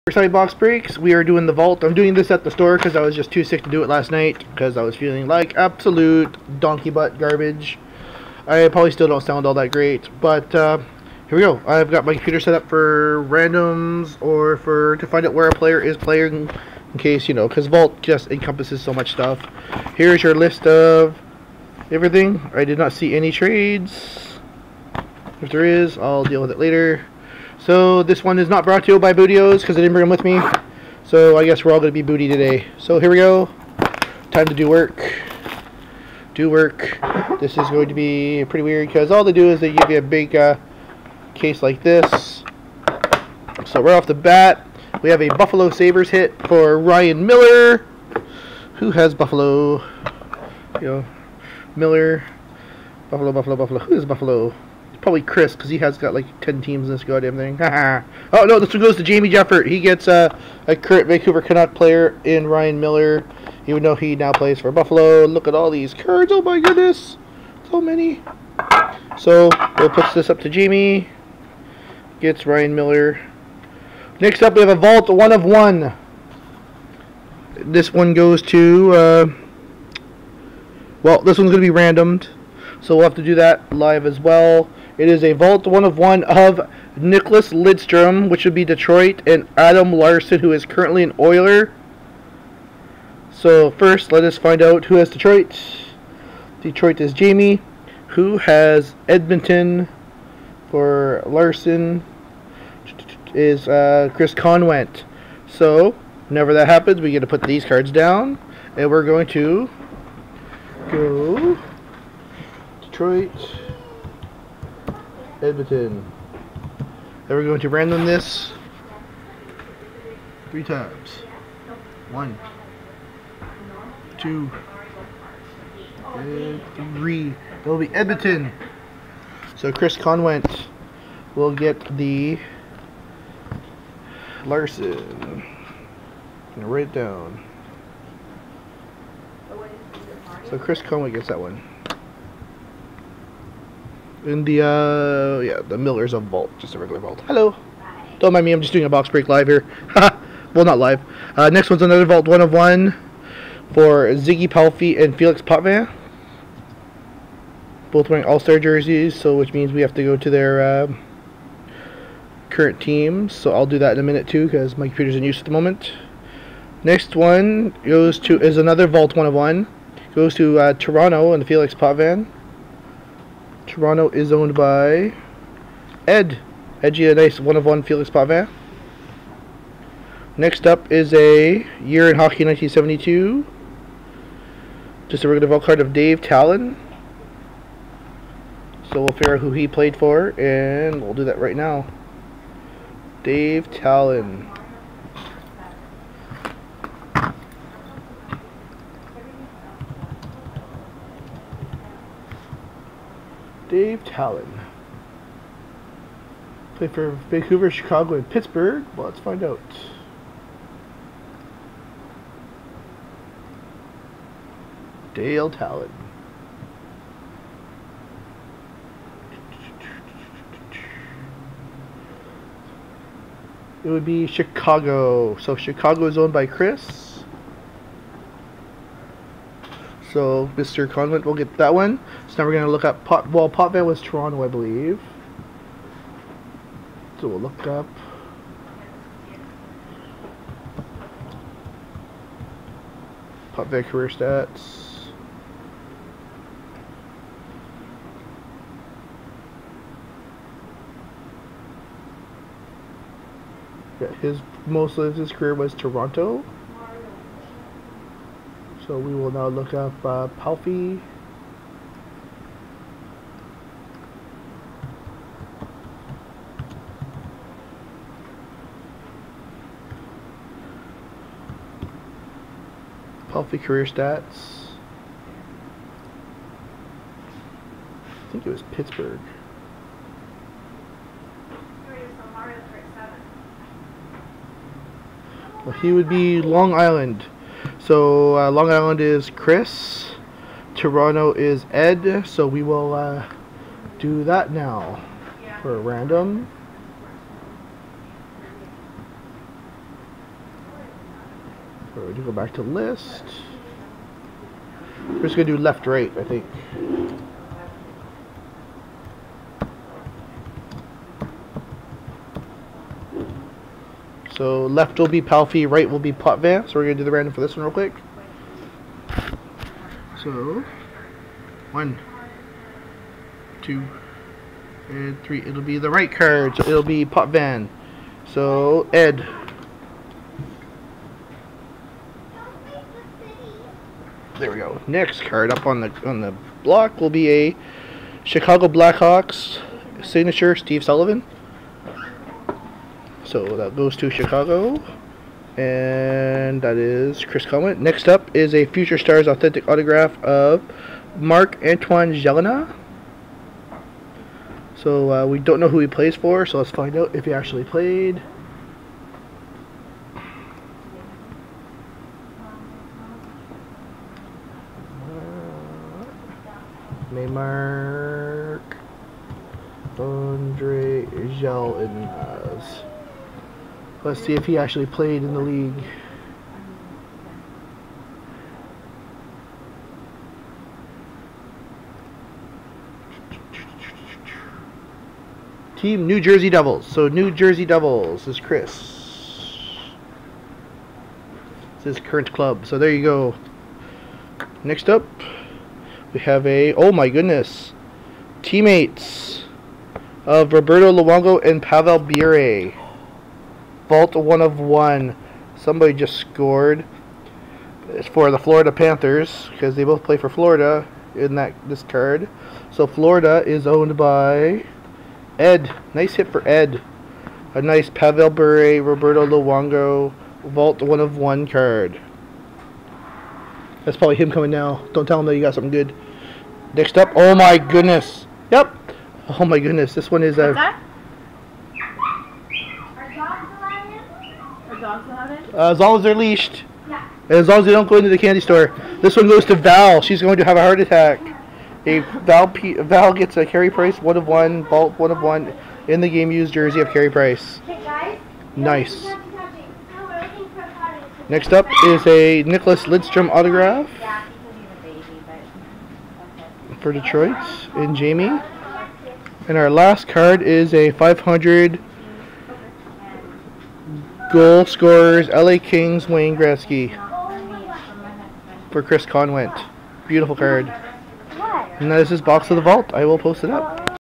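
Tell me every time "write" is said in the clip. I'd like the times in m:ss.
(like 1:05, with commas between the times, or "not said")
2:16.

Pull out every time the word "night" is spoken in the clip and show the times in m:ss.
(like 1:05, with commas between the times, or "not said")
0:04.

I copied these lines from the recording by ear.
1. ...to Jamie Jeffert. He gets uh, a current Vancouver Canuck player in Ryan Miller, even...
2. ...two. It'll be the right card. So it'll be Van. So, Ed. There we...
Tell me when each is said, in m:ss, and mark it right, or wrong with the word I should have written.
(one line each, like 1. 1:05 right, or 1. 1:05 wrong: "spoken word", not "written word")
1. 0:58 right
2. 5:25 wrong: "three", not "two".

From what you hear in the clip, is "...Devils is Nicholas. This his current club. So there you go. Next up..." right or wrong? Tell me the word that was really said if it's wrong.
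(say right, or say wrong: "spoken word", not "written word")
wrong: "Chris", not "Nicholas".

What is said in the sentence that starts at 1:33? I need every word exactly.
So first, let us find out who has Detroit.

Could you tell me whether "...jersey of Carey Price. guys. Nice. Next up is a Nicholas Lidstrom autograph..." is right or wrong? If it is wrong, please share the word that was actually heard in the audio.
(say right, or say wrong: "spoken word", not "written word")
right.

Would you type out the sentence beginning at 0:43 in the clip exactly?
So right off the bat, we have a Buffalo Sabres hit for Ryan Miller.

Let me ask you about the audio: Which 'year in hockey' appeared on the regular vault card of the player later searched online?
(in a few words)
1972.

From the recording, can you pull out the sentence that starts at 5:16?
So we're going to do the random for this one real quick.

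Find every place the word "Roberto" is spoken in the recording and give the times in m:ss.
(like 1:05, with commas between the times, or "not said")
6:40, 6:58.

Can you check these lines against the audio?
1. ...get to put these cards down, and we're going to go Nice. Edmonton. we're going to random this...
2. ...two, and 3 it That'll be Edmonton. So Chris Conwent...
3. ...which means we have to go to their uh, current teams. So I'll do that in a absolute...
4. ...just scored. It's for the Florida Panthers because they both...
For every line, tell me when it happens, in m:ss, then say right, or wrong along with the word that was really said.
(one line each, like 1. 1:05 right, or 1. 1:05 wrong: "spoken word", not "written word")
1. 1:47 wrong: "Detroit", not "Nice"
2. 2:04 right
3. 2:39 wrong: "minute", not "absolute"
4. 6:45 right.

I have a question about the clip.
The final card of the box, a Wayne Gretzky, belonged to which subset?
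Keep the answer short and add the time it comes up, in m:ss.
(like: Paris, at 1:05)
500 Goal scorers, at 7:40.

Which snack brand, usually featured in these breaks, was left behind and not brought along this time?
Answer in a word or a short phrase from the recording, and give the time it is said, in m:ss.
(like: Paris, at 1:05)
Bootios, at 0:29.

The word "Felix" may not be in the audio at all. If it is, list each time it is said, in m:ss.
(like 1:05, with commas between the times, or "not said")
2:35, 2:51, 2:57.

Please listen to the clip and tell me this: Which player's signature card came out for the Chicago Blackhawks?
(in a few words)
Steve Sullivan.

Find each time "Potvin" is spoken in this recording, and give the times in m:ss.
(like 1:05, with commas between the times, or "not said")
2:35, 2:51, 2:58, 3:53, 4:03, 5:16.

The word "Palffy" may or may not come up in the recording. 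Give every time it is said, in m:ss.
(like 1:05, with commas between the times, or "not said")
2:34, 4:20, 4:33, 5:15.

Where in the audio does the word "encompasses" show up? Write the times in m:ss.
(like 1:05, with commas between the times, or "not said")
0:18.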